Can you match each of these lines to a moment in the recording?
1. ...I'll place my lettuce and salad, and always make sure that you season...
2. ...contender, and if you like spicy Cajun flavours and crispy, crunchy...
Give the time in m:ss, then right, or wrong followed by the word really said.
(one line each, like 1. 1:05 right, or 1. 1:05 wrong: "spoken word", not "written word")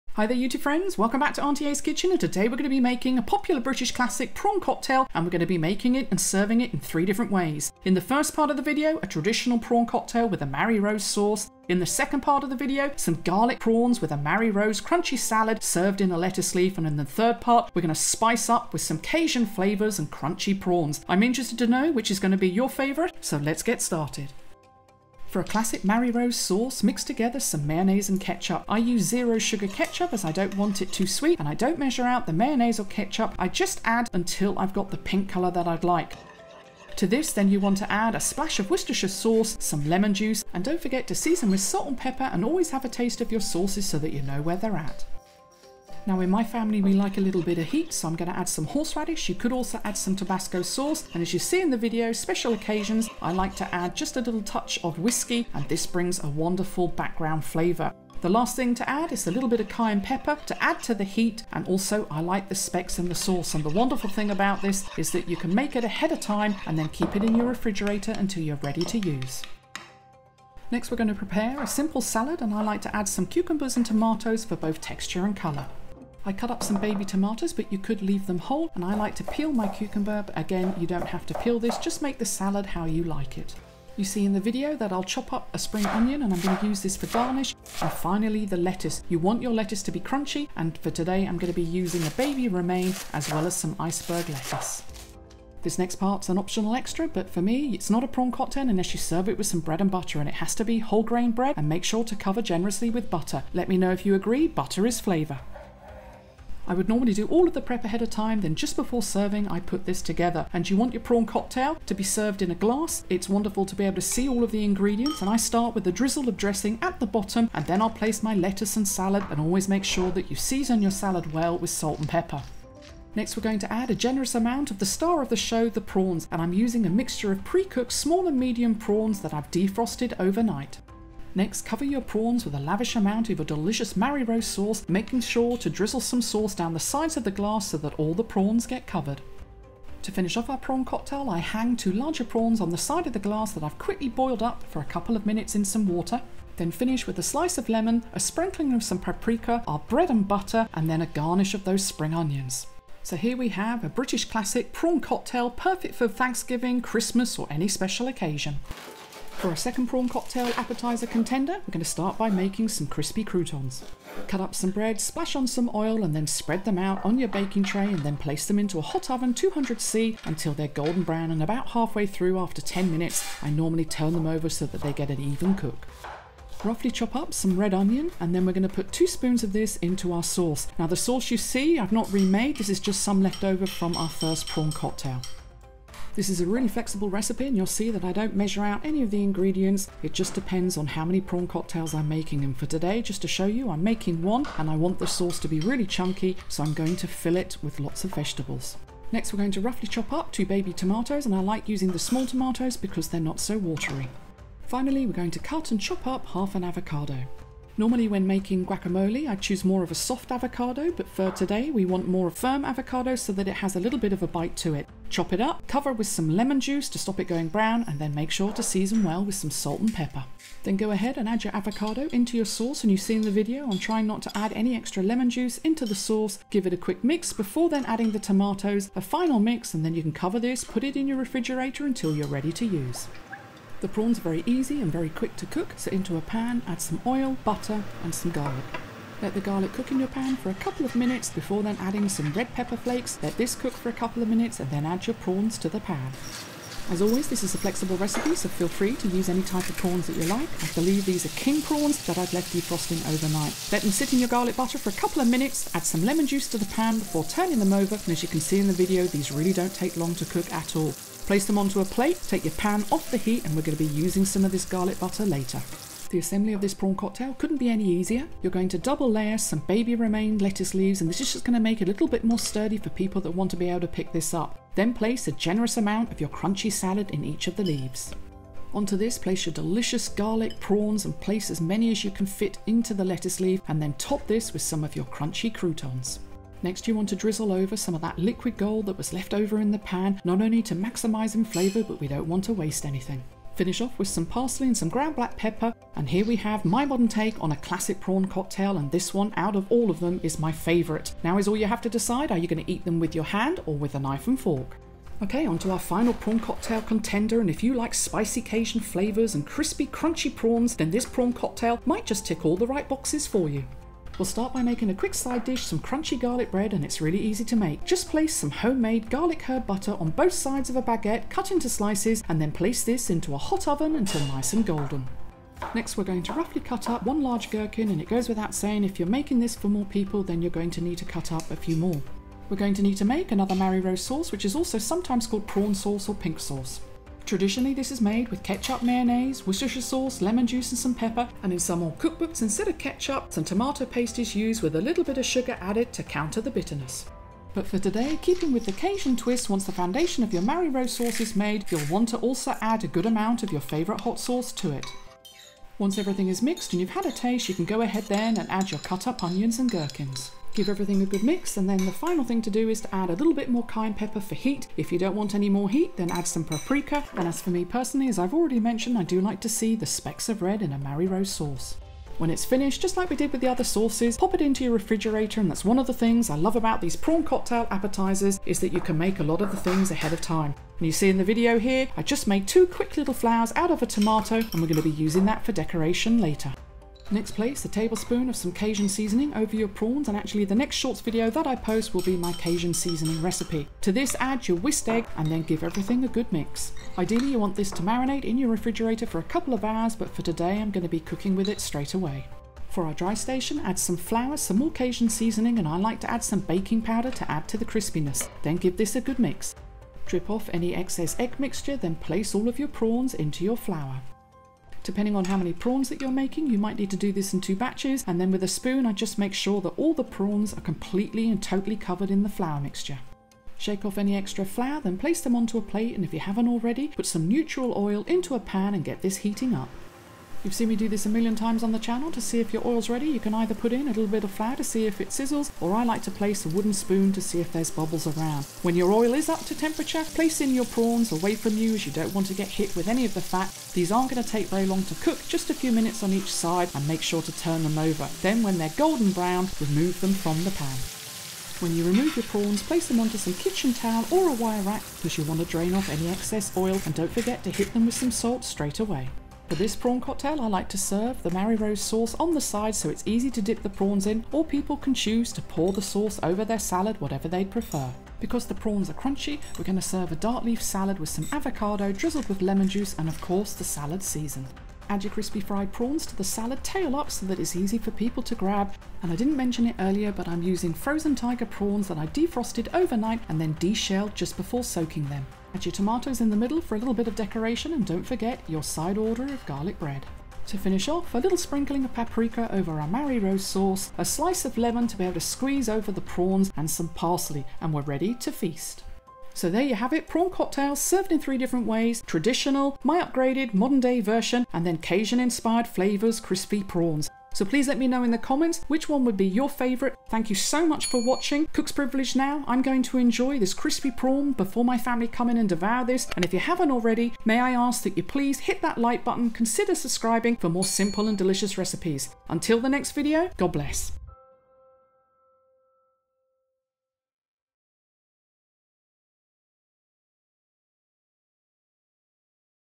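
1. 1:57 right
2. 5:06 right.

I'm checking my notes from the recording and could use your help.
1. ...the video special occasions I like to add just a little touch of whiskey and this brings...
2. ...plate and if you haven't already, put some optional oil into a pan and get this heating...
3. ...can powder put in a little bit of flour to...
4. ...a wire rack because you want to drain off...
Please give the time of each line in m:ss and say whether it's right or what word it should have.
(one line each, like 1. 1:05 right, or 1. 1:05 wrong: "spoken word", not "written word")
1. 0:51 right
2. 7:05 wrong: "neutral", not "optional"
3. 7:13 wrong: "either", not "powder"
4. 7:34 right.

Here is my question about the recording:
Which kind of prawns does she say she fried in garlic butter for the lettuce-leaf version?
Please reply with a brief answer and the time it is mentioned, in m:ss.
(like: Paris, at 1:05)
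King prawns, at 4:11.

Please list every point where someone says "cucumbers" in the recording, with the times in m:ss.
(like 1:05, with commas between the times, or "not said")
1:13, 1:19.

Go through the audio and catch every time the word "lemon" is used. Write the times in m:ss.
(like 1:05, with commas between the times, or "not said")
0:39, 2:27, 3:36, 3:45, 4:16, 5:40, 7:52, 8:14.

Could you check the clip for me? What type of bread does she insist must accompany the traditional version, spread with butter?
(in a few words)
Whole grain bread.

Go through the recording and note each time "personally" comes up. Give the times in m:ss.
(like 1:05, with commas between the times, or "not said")
6:07.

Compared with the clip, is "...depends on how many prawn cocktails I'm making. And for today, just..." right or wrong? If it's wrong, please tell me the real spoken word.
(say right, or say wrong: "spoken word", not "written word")
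right.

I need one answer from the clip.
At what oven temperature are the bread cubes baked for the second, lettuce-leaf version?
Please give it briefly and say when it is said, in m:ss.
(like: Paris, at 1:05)
200C, at 2:49.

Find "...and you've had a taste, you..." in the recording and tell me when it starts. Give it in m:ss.
5:56.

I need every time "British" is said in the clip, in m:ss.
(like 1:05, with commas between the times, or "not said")
0:03, 2:33.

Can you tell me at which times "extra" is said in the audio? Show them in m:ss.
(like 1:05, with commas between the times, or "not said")
1:36, 3:44, 7:04.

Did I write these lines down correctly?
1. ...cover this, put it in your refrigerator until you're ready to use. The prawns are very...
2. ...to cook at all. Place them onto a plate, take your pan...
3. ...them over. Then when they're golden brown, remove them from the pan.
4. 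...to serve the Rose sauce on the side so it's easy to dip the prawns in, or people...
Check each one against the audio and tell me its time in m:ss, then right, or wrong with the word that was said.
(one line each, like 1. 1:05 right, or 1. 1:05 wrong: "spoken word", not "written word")
1. 3:50 right
2. 4:20 right
3. 7:27 right
4. 7:40 right.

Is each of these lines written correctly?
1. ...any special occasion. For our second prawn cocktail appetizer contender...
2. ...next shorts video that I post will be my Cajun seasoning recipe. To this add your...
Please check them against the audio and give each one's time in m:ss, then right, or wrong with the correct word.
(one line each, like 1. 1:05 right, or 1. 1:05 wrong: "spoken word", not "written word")
1. 2:37 right
2. 6:30 right.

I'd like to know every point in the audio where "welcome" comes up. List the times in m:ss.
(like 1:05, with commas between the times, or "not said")
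0:00.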